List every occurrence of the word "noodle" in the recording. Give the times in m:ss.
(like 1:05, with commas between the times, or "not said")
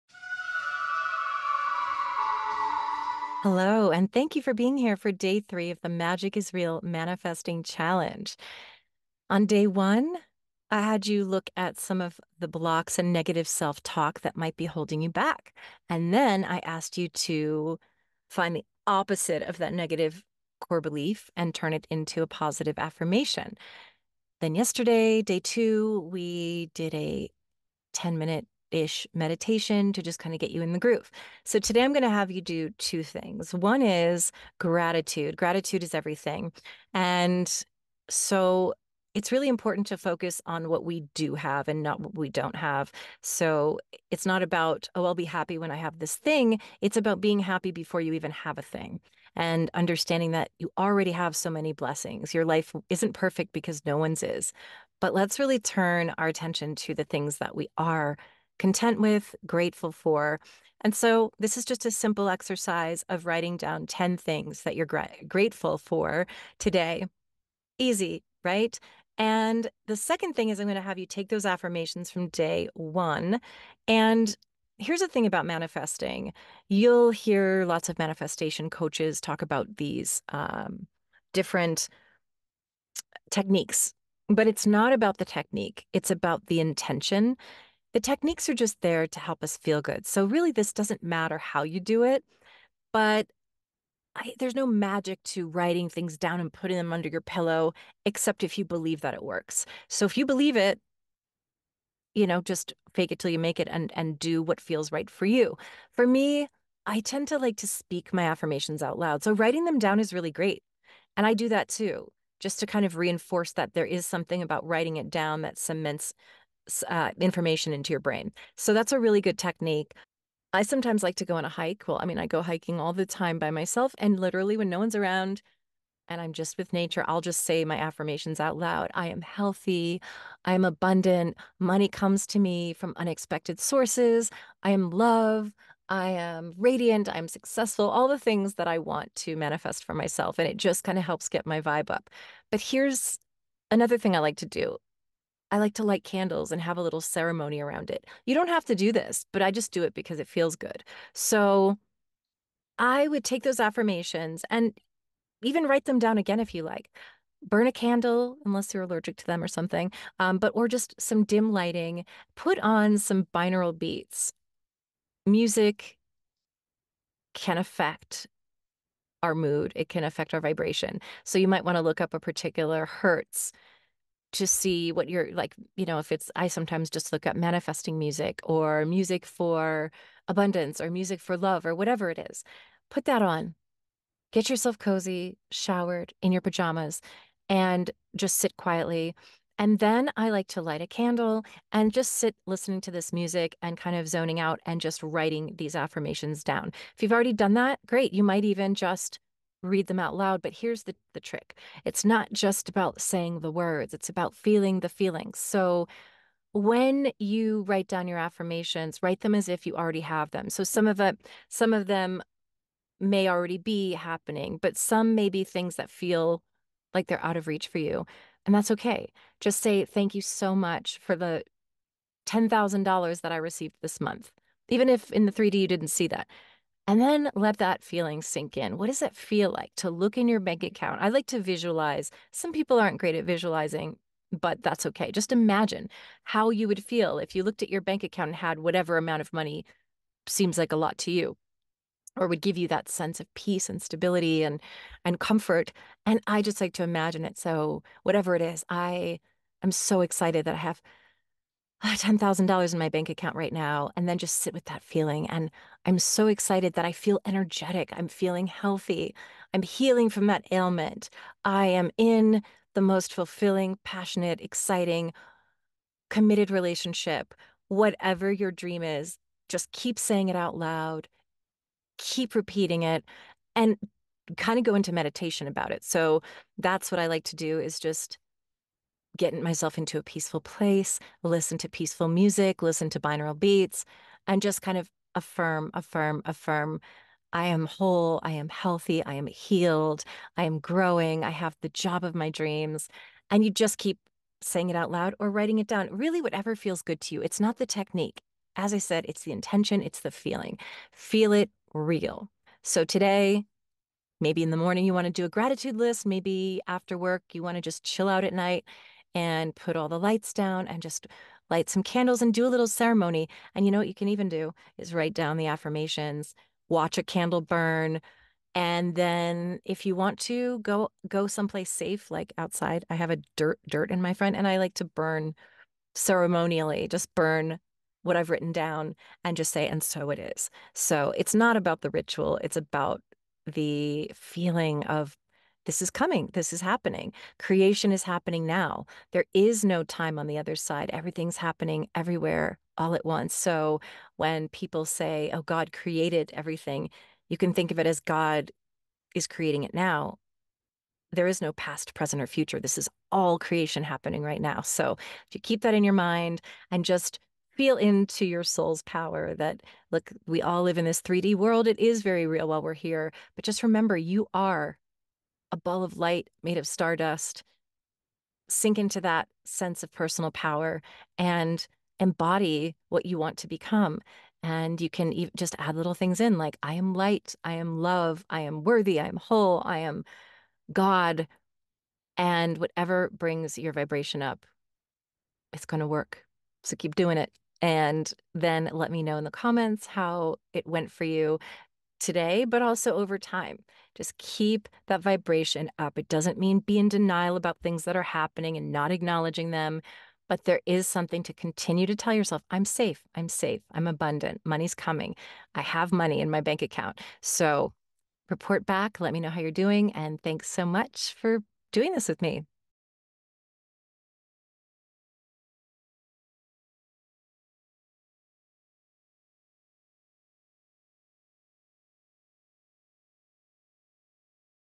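not said.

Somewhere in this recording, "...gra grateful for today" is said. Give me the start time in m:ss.
1:04.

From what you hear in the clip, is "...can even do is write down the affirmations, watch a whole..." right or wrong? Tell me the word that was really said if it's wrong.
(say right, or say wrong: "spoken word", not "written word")
wrong: "candle", not "whole".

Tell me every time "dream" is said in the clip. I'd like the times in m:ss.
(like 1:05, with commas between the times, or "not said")
4:28, 4:52.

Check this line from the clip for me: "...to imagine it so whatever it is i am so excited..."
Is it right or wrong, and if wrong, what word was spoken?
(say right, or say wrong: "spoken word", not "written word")
right.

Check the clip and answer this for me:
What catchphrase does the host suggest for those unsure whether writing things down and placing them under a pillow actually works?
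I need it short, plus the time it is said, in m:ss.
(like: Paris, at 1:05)
Fake it till you make it, at 1:42.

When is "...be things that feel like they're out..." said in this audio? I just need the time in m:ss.
3:35.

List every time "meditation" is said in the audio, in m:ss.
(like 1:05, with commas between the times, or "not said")
0:29, 4:34.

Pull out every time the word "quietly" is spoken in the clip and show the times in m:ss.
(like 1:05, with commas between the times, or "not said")
3:08.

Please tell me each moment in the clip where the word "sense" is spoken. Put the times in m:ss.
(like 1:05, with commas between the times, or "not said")
4:02, 6:09.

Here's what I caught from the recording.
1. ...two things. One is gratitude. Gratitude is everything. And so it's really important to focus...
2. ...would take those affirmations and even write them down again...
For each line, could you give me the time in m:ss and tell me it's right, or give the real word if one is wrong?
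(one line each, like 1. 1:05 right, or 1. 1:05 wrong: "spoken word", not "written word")
1. 0:32 right
2. 2:33 right.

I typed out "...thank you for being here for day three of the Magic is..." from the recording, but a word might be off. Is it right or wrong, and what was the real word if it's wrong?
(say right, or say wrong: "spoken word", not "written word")
right.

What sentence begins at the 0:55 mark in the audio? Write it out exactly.
But let's really turn our attention to the things that we are content with, grateful for.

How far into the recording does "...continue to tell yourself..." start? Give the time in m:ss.
6:41.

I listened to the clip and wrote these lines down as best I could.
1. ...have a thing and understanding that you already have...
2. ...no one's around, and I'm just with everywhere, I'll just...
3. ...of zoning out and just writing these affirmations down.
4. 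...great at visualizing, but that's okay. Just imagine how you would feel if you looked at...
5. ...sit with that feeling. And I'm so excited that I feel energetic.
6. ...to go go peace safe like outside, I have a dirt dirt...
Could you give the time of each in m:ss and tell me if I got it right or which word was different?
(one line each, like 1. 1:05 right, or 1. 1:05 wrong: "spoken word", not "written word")
1. 0:48 right
2. 2:04 wrong: "nature", not "everywhere"
3. 3:13 right
4. 3:52 right
5. 4:14 right
6. 5:20 wrong: "someplace", not "peace".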